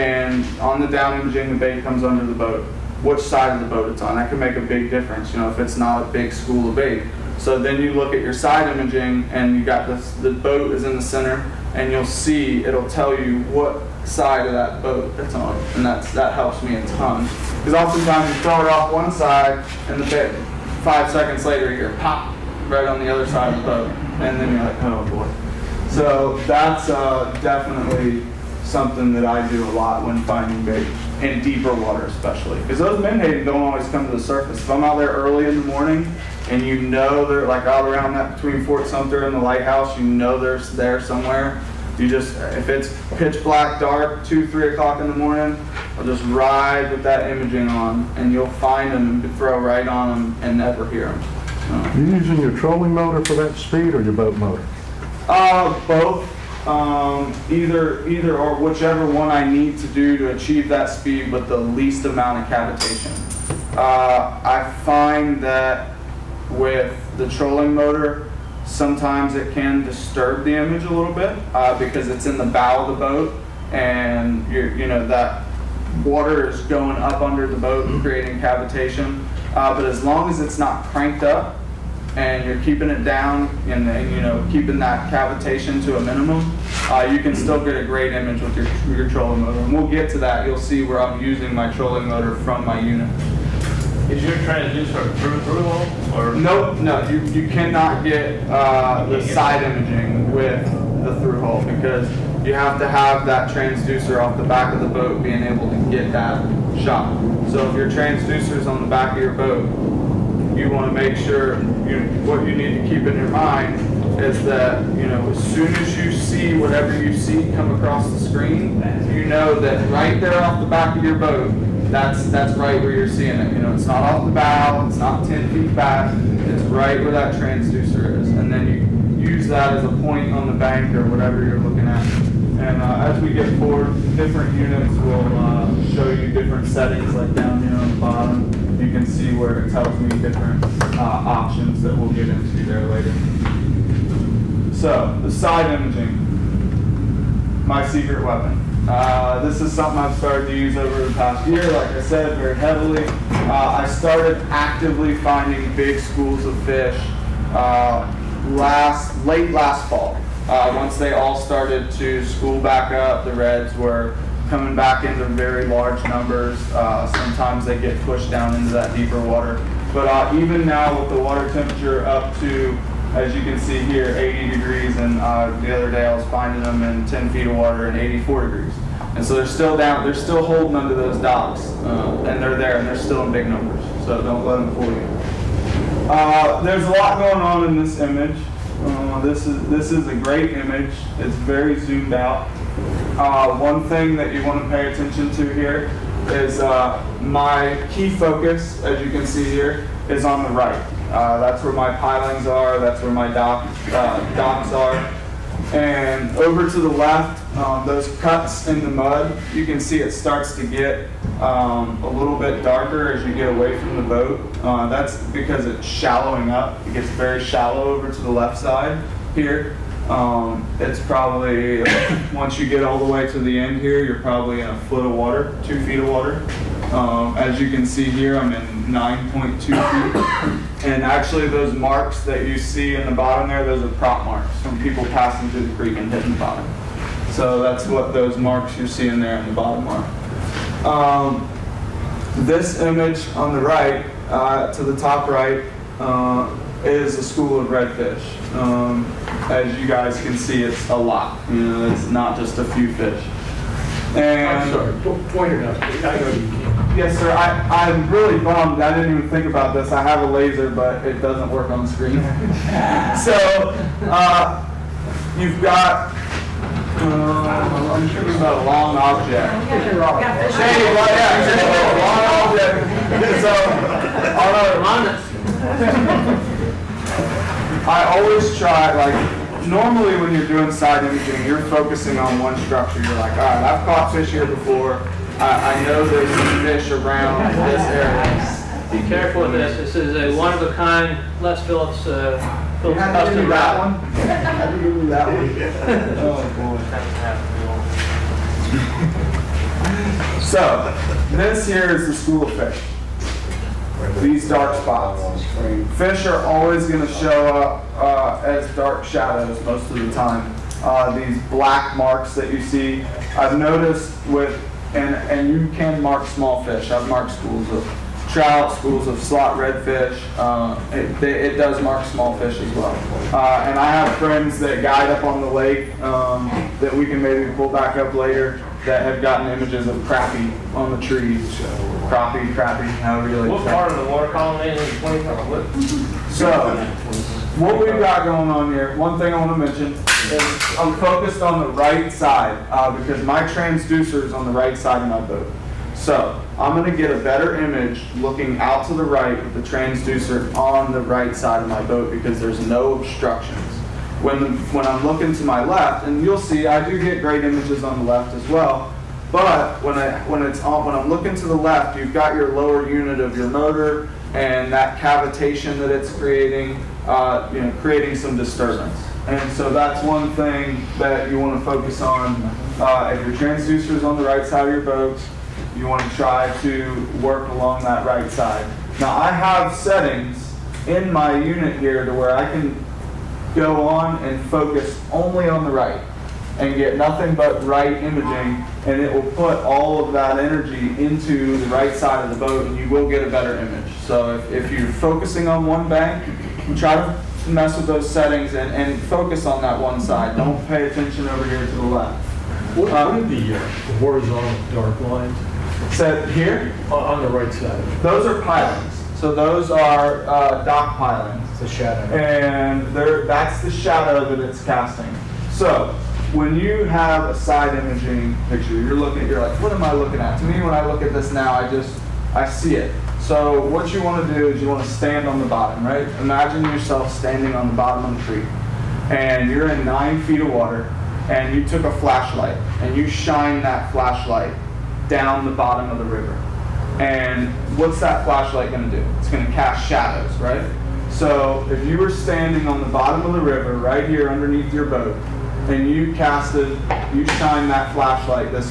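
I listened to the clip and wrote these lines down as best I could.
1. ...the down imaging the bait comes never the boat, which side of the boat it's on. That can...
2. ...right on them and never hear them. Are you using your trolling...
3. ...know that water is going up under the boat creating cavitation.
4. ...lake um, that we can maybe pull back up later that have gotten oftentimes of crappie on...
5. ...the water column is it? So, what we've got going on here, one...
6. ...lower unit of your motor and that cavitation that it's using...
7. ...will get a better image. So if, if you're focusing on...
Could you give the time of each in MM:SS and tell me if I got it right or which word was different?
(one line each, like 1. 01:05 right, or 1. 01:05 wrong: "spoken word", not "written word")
1. 00:00 wrong: "under", not "never"
2. 00:49 right
3. 01:14 right
4. 05:25 wrong: "images", not "oftentimes"
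5. 05:34 right
6. 06:02 wrong: "creating", not "using"
7. 06:32 right.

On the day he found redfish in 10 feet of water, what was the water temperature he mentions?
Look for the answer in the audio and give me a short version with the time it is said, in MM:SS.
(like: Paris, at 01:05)
84 degrees, at 02:57.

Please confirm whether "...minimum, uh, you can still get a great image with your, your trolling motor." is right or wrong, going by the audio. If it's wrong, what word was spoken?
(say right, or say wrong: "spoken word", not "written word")
right.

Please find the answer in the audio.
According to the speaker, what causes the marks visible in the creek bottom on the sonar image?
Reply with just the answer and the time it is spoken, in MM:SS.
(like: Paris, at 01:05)
Prop marks, at 03:53.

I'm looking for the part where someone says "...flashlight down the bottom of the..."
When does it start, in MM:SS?
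07:13.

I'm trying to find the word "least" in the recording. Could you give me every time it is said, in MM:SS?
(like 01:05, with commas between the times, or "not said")
01:01.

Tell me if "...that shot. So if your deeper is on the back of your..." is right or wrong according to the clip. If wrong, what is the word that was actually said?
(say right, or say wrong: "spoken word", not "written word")
wrong: "transducer", not "deeper".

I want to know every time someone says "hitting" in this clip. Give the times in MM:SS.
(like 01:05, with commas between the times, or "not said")
03:56.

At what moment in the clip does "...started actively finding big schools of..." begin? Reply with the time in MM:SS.
02:33.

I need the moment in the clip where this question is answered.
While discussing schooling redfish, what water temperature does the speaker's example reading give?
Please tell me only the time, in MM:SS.
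02:54.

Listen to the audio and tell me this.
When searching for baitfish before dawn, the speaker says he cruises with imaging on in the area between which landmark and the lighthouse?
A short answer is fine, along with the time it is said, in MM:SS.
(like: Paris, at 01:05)
Fort Sumter, at 00:38.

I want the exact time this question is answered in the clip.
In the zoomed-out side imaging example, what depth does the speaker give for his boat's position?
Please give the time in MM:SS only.
03:48.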